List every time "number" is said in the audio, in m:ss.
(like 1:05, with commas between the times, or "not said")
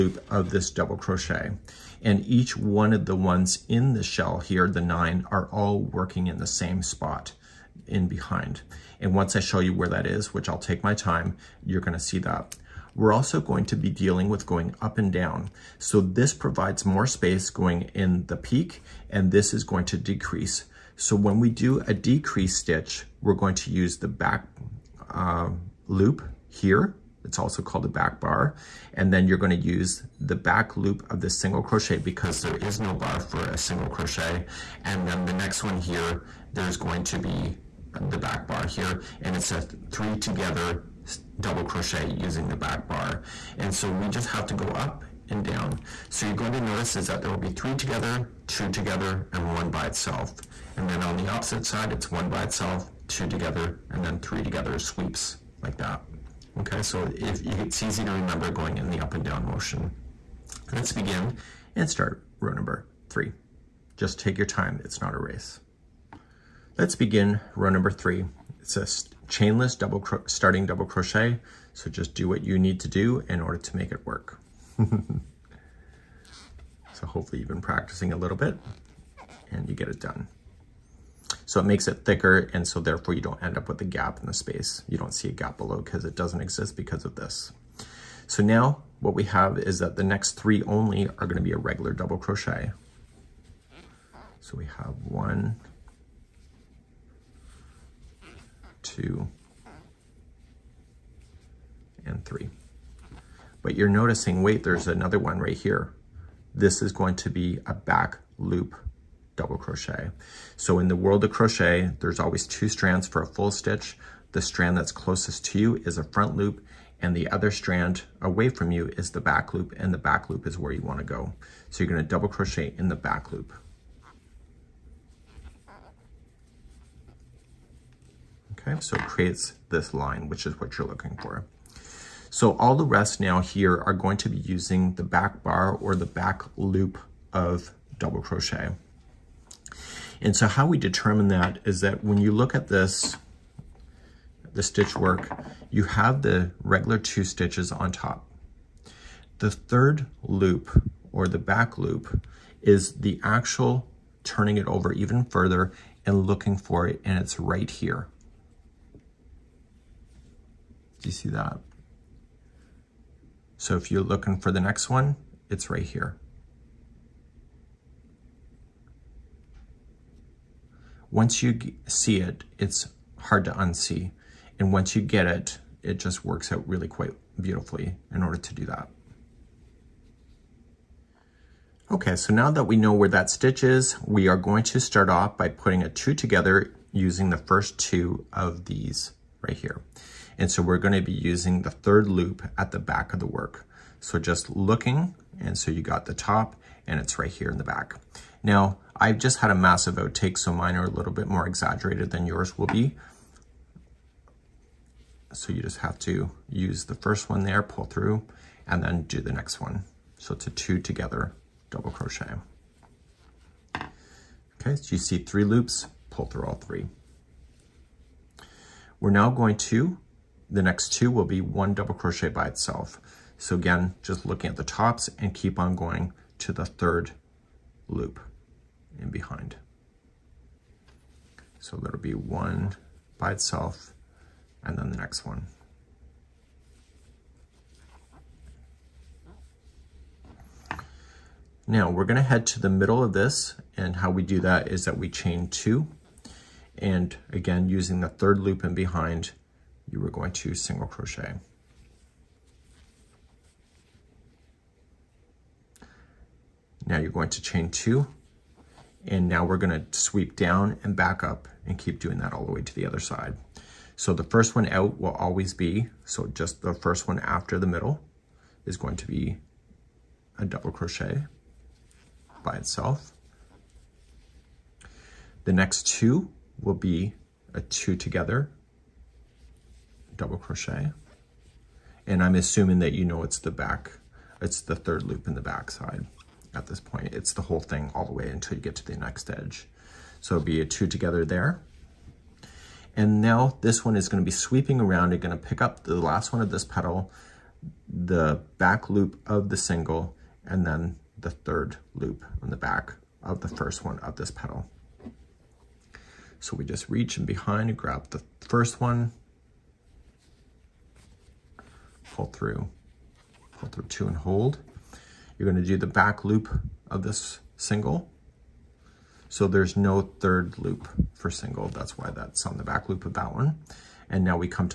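1:02, 1:07.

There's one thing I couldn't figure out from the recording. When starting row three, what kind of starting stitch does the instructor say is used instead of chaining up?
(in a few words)
chainless double.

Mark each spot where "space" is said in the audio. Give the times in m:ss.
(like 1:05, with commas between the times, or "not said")
0:17, 1:24.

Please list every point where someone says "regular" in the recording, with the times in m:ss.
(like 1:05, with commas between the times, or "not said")
1:31, 2:26.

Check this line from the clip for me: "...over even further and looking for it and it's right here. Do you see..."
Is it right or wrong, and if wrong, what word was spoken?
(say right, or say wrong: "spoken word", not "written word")
right.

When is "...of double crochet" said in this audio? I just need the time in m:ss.
2:17.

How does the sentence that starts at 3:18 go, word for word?
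Now, I've just had a massive outtake, so mine are a little bit more exaggerated than yours will be.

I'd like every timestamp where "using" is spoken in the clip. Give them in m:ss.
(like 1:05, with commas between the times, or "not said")
0:42, 2:14, 3:06, 3:11, 4:07.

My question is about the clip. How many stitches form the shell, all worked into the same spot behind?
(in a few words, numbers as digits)
9.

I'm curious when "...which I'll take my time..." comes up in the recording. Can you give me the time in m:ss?
0:10.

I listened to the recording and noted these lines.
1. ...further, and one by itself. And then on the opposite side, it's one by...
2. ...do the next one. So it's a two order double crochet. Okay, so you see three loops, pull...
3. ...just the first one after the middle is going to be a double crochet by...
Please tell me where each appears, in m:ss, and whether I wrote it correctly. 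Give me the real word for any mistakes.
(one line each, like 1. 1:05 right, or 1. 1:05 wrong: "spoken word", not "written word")
1. 0:48 wrong: "together", not "further"
2. 3:29 wrong: "together", not "order"
3. 4:26 right.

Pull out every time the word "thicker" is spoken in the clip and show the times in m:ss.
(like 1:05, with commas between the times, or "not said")
1:22.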